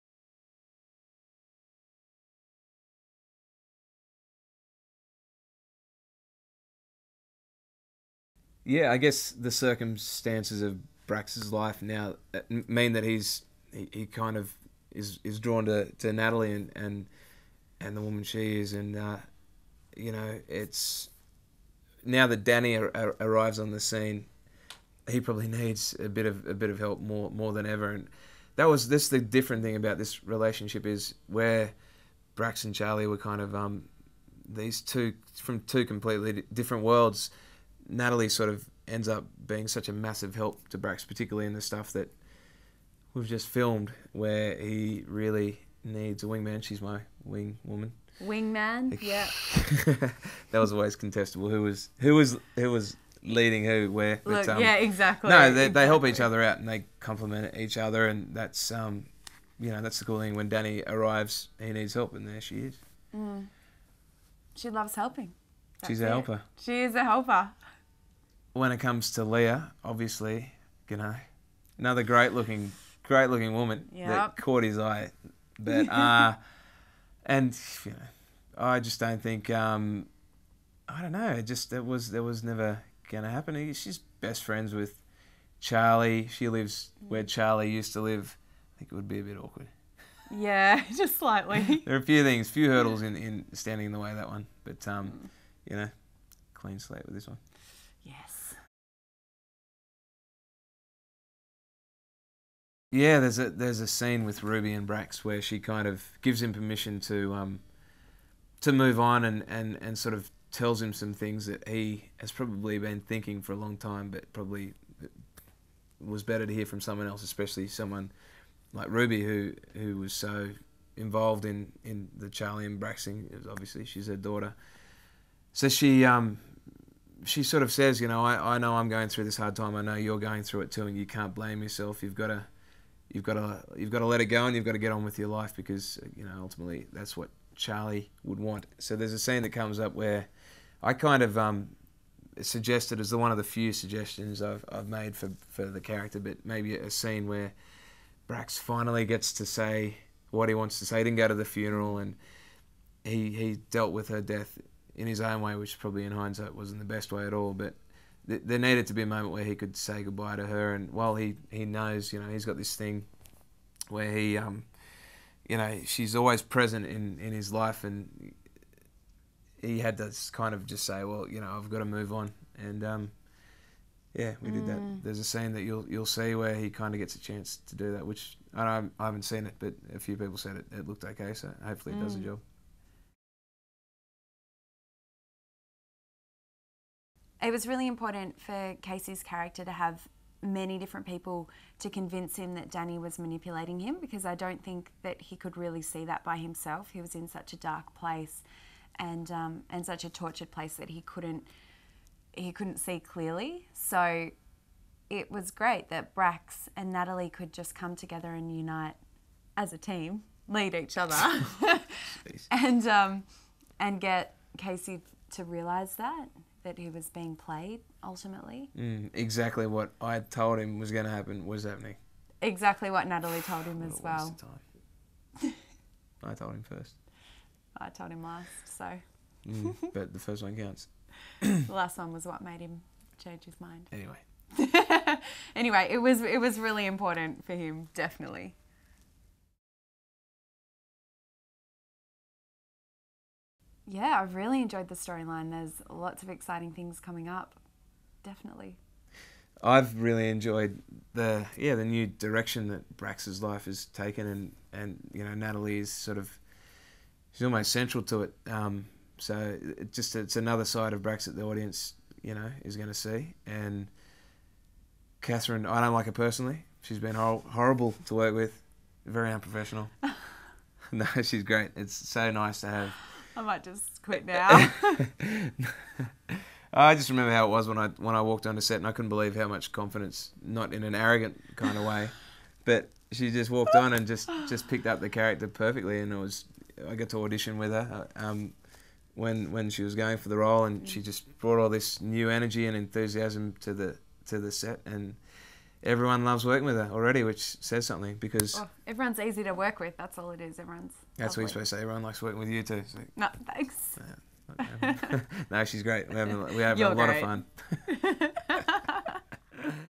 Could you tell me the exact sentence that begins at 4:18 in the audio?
Um, so it just it's another side of Brax that the audience you know is going to see.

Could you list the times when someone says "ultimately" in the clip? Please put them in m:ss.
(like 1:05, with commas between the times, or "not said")
2:16, 3:38.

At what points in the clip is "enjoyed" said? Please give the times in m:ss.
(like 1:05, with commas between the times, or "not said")
4:04, 4:10.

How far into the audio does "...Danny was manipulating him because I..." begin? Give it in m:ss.
3:12.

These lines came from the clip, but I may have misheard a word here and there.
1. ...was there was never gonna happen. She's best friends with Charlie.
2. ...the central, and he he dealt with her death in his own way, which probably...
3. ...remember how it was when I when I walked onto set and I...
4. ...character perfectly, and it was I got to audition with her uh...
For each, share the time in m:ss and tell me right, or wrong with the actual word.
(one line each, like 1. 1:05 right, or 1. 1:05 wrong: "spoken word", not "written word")
1. 1:21 right
2. 2:31 wrong: "funeral", not "central"
3. 4:37 right
4. 4:45 right.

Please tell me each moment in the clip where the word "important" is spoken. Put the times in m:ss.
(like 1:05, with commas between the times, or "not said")
3:07, 3:56.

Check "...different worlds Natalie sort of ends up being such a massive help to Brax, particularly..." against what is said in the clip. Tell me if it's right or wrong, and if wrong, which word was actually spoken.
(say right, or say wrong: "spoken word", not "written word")
right.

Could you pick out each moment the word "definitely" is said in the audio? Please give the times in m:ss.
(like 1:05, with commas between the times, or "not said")
3:57, 4:08.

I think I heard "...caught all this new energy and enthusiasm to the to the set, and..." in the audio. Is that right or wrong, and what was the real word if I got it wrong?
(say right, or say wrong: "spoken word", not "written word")
wrong: "brought", not "caught".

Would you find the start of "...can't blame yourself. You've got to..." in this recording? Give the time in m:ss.
2:11.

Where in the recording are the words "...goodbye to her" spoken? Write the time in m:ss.
2:40.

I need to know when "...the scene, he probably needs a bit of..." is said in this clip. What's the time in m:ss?
0:23.